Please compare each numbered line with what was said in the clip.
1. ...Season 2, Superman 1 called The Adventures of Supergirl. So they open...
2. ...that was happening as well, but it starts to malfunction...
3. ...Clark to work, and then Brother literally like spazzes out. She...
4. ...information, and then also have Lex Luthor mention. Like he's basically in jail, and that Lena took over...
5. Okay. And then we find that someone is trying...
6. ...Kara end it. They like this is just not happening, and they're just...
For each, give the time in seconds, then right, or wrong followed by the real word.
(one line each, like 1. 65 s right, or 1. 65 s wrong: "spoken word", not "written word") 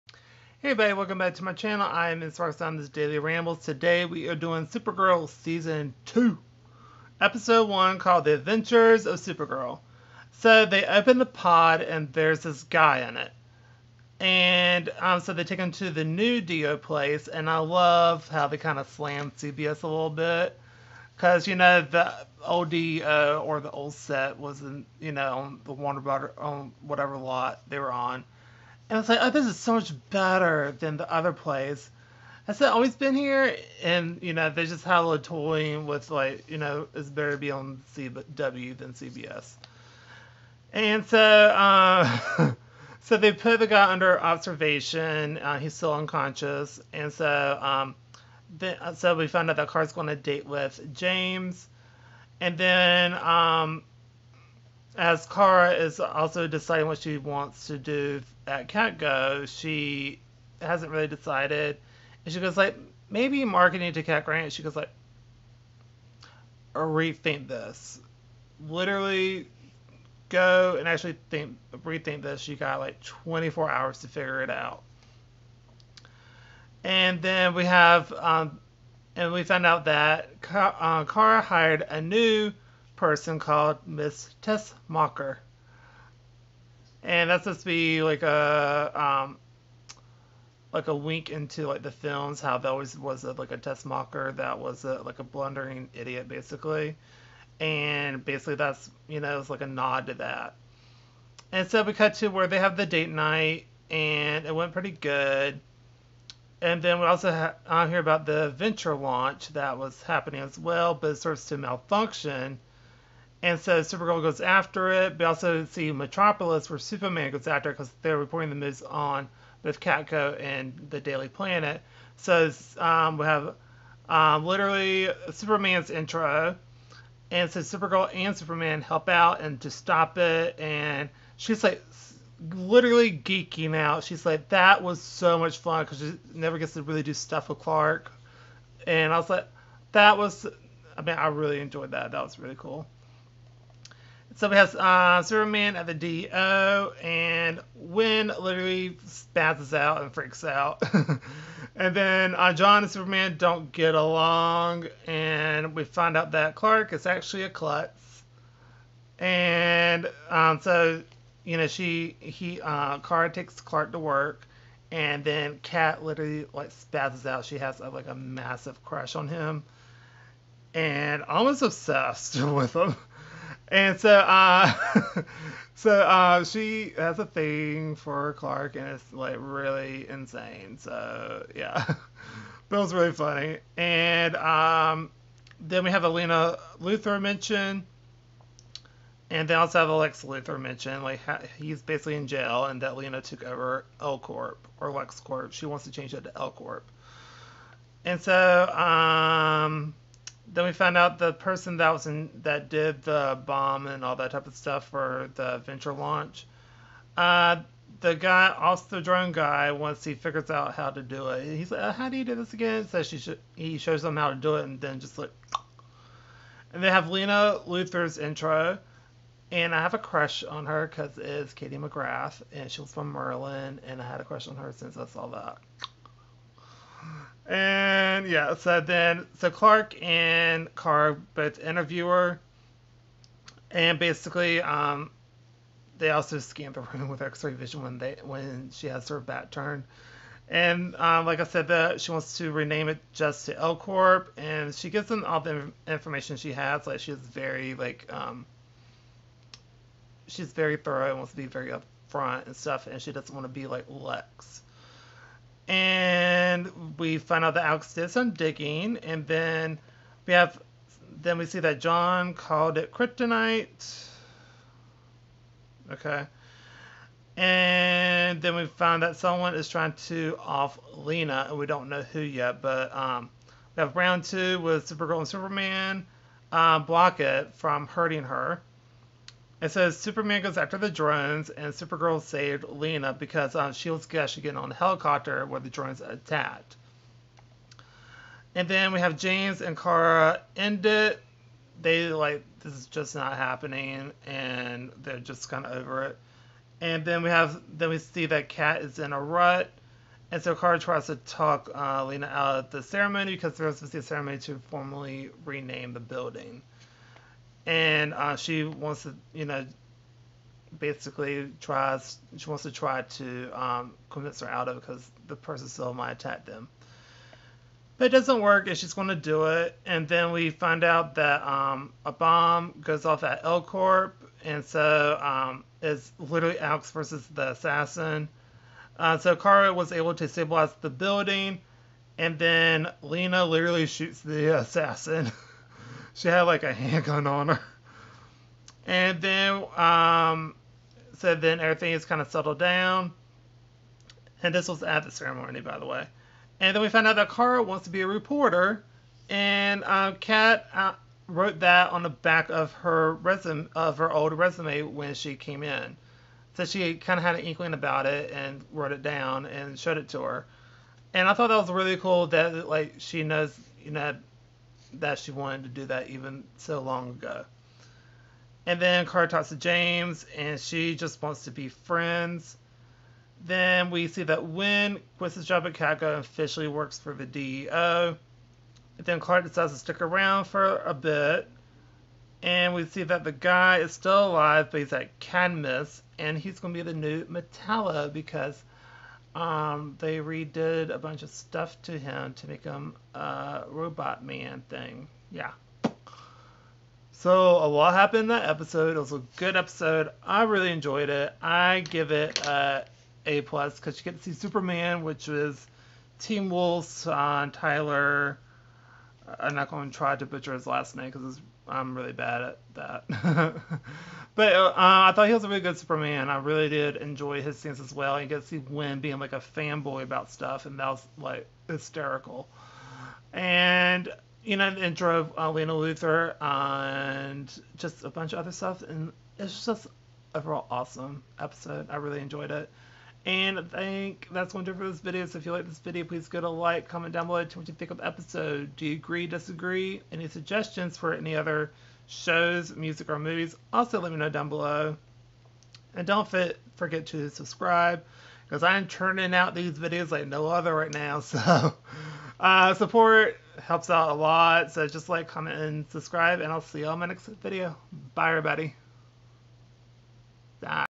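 1. 5 s wrong: "Episode", not "Superman"
2. 109 s right
3. 163 s wrong: "Cat", not "Brother"
4. 187 s wrong: "mention", not "information"
5. 265 s right
6. 289 s right.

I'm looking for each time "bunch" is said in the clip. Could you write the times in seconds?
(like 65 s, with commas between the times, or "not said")
390 s, 428 s.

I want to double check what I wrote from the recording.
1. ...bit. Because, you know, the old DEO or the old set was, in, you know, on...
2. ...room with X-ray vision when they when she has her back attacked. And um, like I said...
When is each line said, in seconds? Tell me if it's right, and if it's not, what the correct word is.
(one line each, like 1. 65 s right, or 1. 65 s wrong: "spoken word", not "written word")
1. 20 s right
2. 236 s wrong: "turned", not "attacked".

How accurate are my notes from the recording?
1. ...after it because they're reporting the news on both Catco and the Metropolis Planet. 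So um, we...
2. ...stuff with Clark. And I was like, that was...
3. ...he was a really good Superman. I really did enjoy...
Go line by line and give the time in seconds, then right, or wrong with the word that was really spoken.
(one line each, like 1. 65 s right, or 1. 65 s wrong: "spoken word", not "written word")
1. 117 s wrong: "Daily", not "Metropolis"
2. 137 s right
3. 415 s right.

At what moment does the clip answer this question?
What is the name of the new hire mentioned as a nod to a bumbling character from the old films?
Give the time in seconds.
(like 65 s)
83 s.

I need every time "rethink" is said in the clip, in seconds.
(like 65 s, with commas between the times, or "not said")
66 s, 71 s.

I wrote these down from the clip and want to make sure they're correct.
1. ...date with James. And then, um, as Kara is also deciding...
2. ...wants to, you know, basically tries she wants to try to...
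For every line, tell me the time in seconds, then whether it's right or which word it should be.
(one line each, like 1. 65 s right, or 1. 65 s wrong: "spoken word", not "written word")
1. 50 s right
2. 308 s right.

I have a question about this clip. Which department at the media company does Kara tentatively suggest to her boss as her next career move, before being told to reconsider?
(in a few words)
Marketing.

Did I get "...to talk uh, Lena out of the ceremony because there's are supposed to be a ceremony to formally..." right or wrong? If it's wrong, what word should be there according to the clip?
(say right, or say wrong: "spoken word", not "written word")
right.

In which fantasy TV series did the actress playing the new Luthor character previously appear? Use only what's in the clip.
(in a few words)
Merlin.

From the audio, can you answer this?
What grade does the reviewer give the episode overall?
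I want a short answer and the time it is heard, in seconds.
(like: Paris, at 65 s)
A plus, at 403 s.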